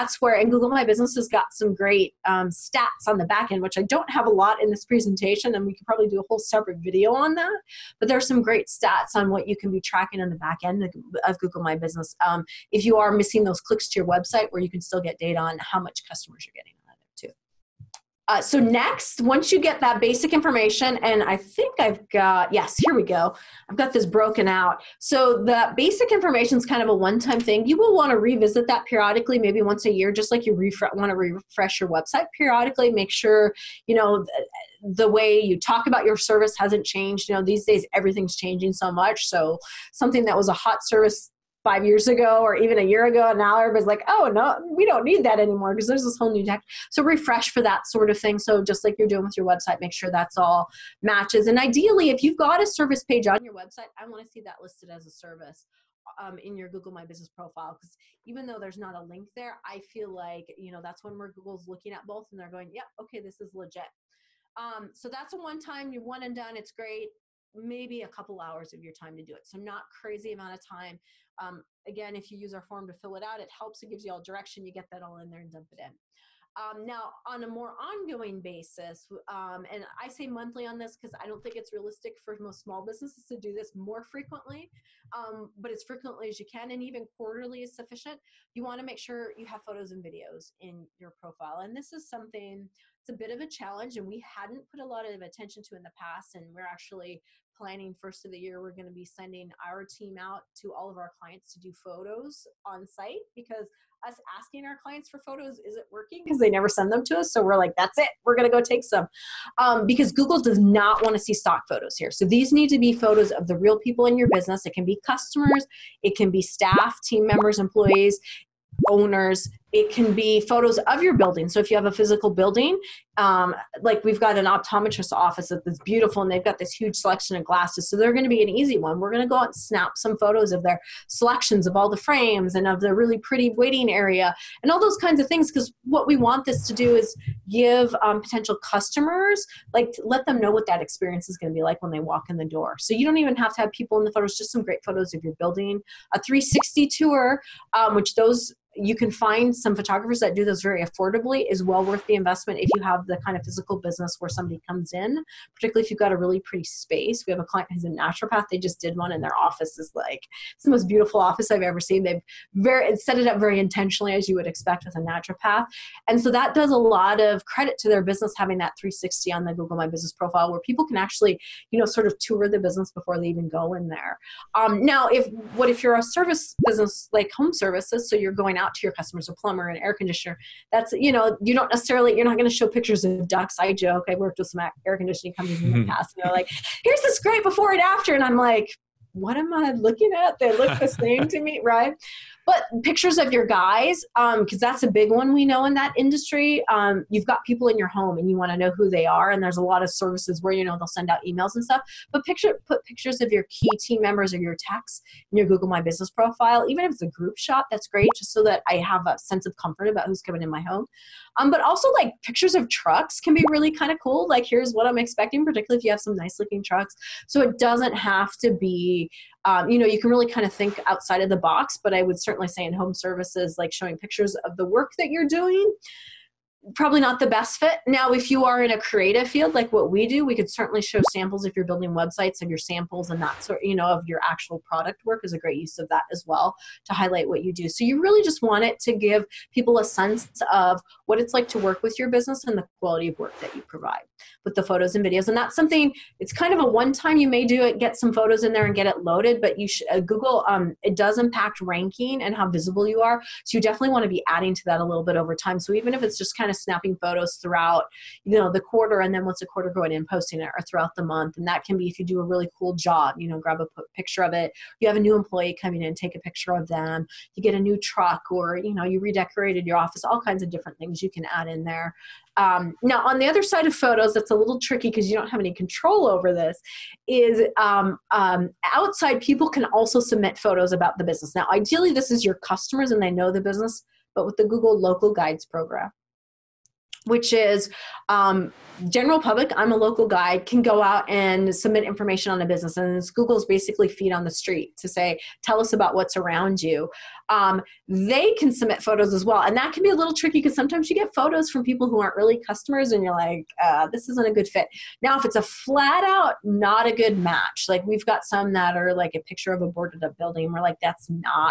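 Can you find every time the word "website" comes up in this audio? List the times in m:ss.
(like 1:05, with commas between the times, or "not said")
0:14, 0:31, 0:49, 0:53, 3:51.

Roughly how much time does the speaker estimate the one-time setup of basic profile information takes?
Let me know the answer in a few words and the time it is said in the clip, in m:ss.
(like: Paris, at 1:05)
a couple hours, at 1:08.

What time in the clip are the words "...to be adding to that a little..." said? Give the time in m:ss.
4:14.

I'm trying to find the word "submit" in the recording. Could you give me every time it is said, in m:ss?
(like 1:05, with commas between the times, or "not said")
4:40, 4:51, 4:58.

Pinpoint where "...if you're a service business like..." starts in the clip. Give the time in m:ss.
2:55.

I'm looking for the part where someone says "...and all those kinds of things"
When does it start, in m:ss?
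2:14.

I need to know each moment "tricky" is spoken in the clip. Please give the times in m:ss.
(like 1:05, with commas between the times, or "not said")
4:34, 5:00.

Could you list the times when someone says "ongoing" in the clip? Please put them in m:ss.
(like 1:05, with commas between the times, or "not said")
1:17.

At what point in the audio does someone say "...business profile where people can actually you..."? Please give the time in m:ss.
2:49.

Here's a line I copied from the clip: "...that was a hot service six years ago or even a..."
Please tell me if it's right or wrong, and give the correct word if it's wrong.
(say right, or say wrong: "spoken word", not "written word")
wrong: "five", not "six".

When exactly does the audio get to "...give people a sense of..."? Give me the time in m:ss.
3:58.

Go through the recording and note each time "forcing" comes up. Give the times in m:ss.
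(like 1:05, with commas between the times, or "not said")
not said.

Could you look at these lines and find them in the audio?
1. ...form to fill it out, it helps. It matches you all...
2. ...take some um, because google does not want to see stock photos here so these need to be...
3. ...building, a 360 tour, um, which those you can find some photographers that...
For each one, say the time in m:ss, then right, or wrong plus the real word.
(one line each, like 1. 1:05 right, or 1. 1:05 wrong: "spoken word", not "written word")
1. 1:12 wrong: "gives", not "matches"
2. 1:48 right
3. 2:25 right.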